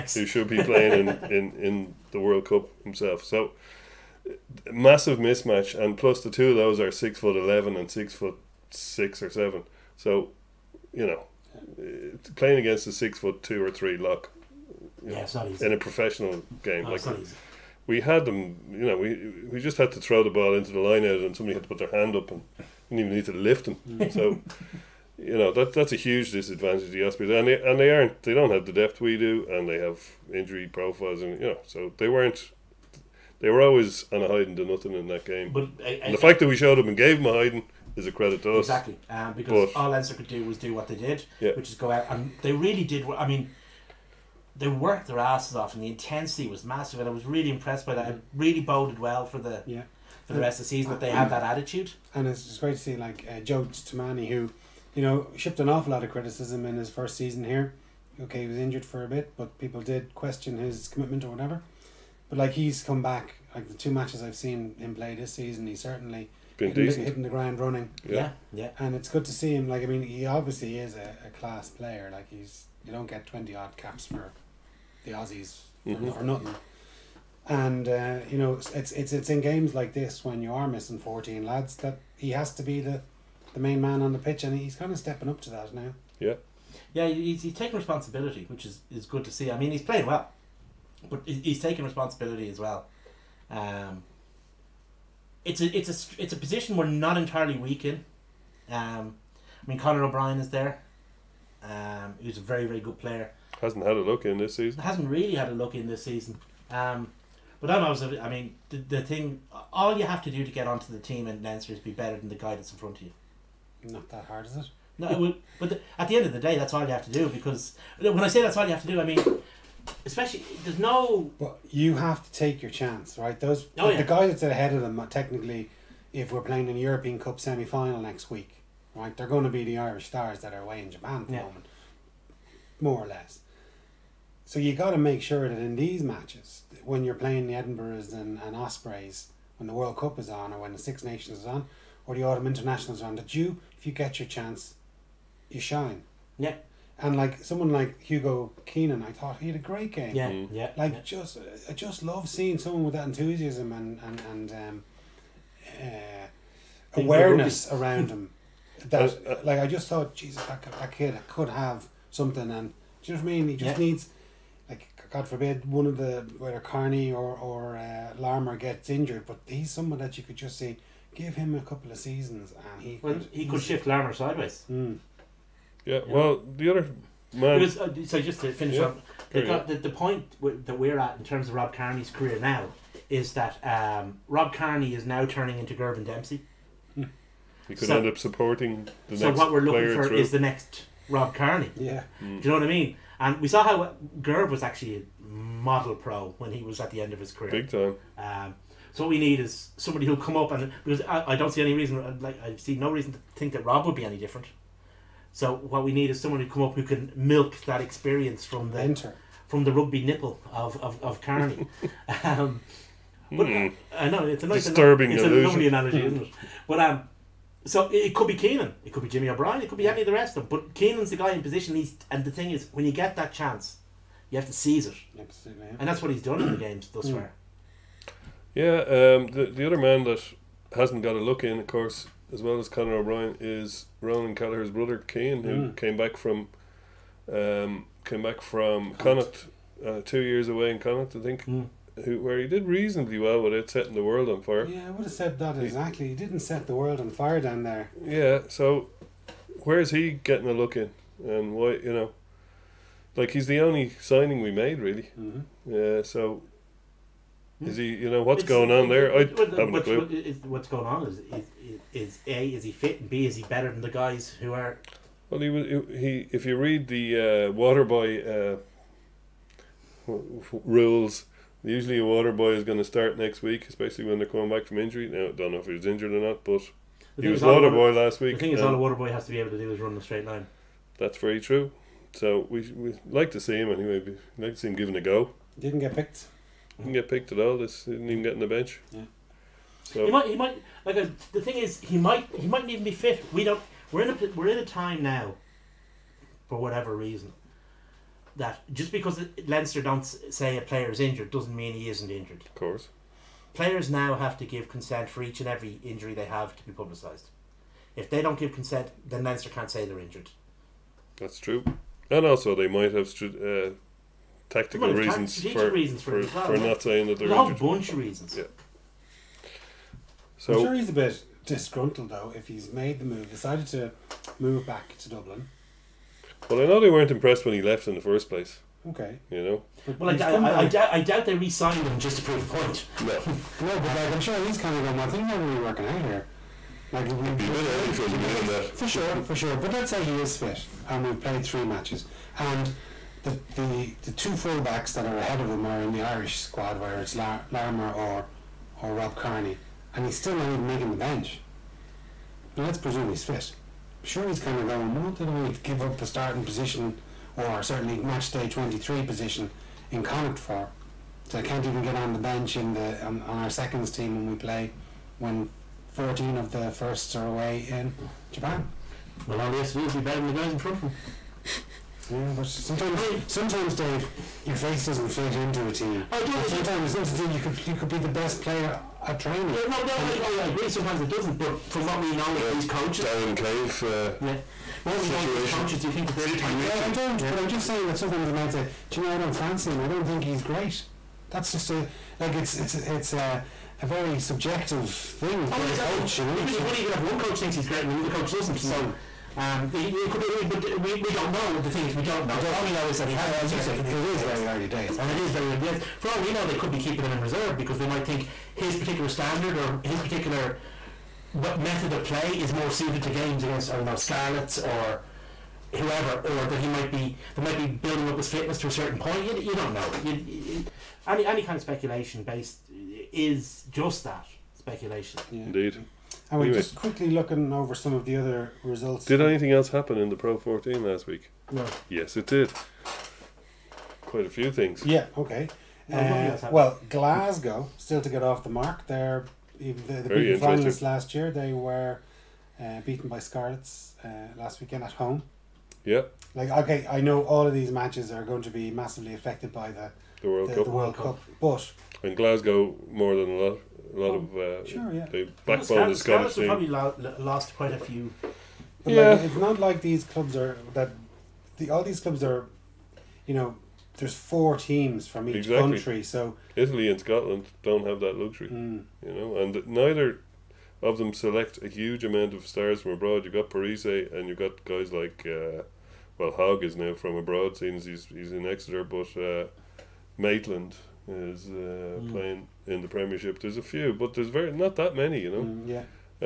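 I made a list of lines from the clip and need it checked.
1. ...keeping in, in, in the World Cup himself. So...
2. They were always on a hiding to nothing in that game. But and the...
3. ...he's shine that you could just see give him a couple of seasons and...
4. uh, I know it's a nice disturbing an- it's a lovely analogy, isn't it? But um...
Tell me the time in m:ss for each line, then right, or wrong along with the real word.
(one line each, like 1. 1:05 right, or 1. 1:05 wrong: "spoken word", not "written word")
1. 0:00 wrong: "playing", not "keeping"
2. 0:33 right
3. 2:49 wrong: "someone", not "shine"
4. 3:33 right.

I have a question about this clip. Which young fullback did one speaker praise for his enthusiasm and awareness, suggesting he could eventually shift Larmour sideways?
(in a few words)
Hugo Keenan.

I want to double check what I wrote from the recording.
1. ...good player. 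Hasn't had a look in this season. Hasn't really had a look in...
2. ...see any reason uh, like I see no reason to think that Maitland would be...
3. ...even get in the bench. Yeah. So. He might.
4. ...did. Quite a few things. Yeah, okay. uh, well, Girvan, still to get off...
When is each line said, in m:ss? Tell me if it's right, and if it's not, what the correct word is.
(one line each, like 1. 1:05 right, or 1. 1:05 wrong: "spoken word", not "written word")
1. 1:42 right
2. 3:21 wrong: "Rob", not "Maitland"
3. 4:48 right
4. 7:12 wrong: "Glasgow", not "Girvan".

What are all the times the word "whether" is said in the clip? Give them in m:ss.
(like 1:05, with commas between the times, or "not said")
2:46, 5:46.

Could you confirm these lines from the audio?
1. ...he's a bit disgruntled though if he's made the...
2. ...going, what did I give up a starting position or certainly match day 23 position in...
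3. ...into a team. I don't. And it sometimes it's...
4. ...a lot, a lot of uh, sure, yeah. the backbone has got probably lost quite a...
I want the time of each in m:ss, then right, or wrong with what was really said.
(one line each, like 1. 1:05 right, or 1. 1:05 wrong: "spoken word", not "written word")
1. 5:20 right
2. 5:54 right
3. 6:15 right
4. 7:33 right.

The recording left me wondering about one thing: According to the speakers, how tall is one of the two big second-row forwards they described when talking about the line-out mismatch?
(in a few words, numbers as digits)
6 foot 11.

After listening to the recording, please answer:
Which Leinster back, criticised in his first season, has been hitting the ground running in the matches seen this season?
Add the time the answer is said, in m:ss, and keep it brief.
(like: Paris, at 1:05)
Joe Tomane, at 0:53.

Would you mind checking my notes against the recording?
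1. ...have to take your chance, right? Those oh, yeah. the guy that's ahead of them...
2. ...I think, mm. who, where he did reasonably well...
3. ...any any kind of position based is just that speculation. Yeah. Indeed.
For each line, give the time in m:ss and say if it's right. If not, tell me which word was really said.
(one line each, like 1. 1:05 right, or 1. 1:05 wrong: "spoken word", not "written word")
1. 2:01 right
2. 4:01 right
3. 7:01 wrong: "speculation", not "position".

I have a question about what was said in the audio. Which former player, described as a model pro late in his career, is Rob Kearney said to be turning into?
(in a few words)
Girvan Dempsey.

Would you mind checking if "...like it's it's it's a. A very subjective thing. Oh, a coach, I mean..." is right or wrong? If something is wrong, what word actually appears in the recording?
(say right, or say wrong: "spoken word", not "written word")
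right.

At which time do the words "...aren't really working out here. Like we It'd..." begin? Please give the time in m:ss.
5:35.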